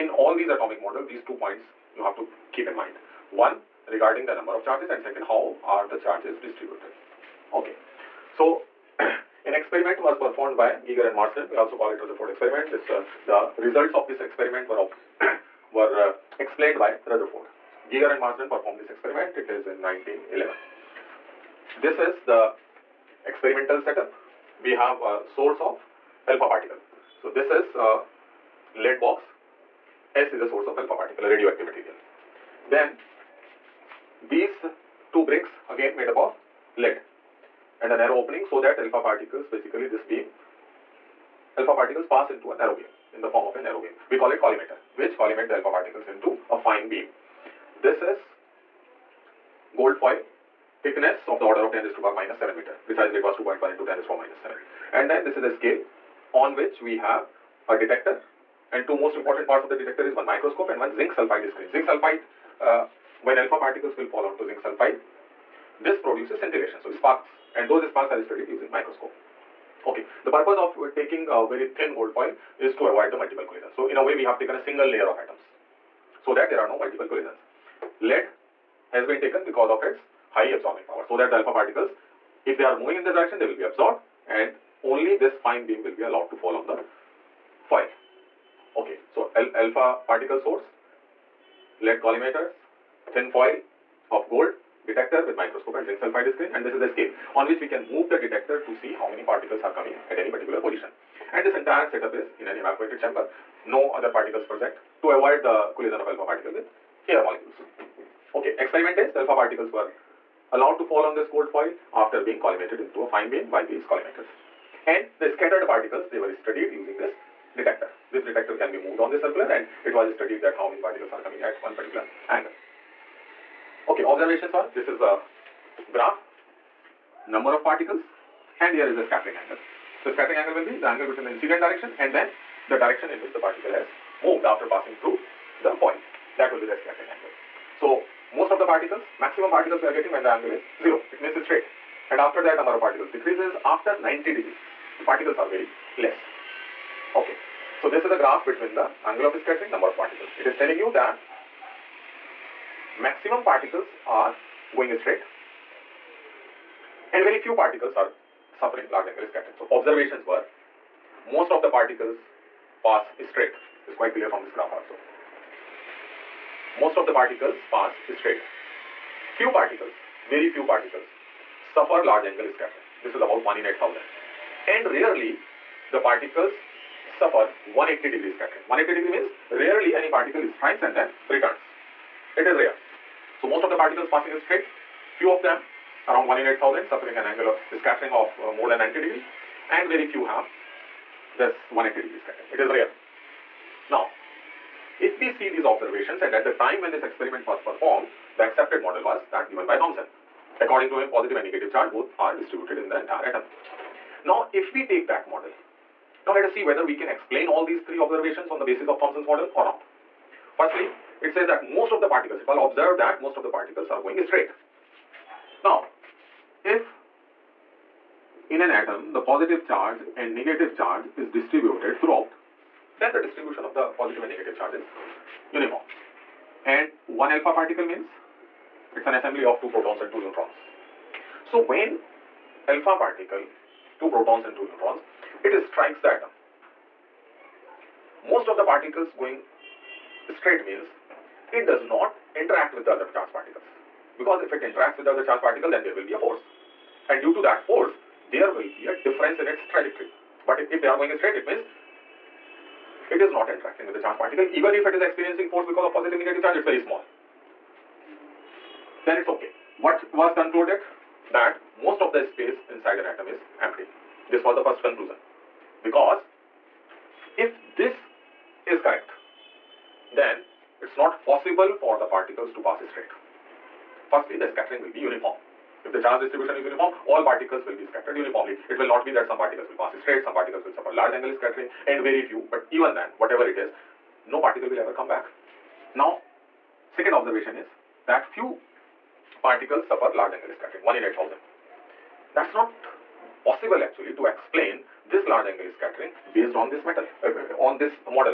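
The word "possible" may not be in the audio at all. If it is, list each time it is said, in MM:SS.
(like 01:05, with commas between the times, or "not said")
04:31, 04:53.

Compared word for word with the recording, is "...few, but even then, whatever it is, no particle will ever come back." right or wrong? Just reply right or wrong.
right.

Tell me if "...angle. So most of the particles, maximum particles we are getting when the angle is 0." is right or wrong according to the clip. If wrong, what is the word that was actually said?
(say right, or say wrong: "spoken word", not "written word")
right.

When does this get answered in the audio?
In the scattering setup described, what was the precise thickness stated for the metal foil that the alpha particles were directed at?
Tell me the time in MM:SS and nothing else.
00:53.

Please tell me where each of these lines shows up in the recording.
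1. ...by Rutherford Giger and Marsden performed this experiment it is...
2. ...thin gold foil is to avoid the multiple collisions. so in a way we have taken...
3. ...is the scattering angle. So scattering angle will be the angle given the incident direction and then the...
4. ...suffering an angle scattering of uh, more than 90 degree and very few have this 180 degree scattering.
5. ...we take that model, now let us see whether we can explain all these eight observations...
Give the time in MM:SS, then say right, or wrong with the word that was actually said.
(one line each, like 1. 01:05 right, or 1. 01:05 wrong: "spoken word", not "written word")
1. 00:16 right
2. 01:11 right
3. 02:08 wrong: "between", not "given"
4. 03:06 right
5. 03:24 wrong: "three", not "eight".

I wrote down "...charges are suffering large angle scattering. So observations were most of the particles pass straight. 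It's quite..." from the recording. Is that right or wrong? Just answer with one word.
wrong.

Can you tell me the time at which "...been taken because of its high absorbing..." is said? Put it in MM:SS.
01:19.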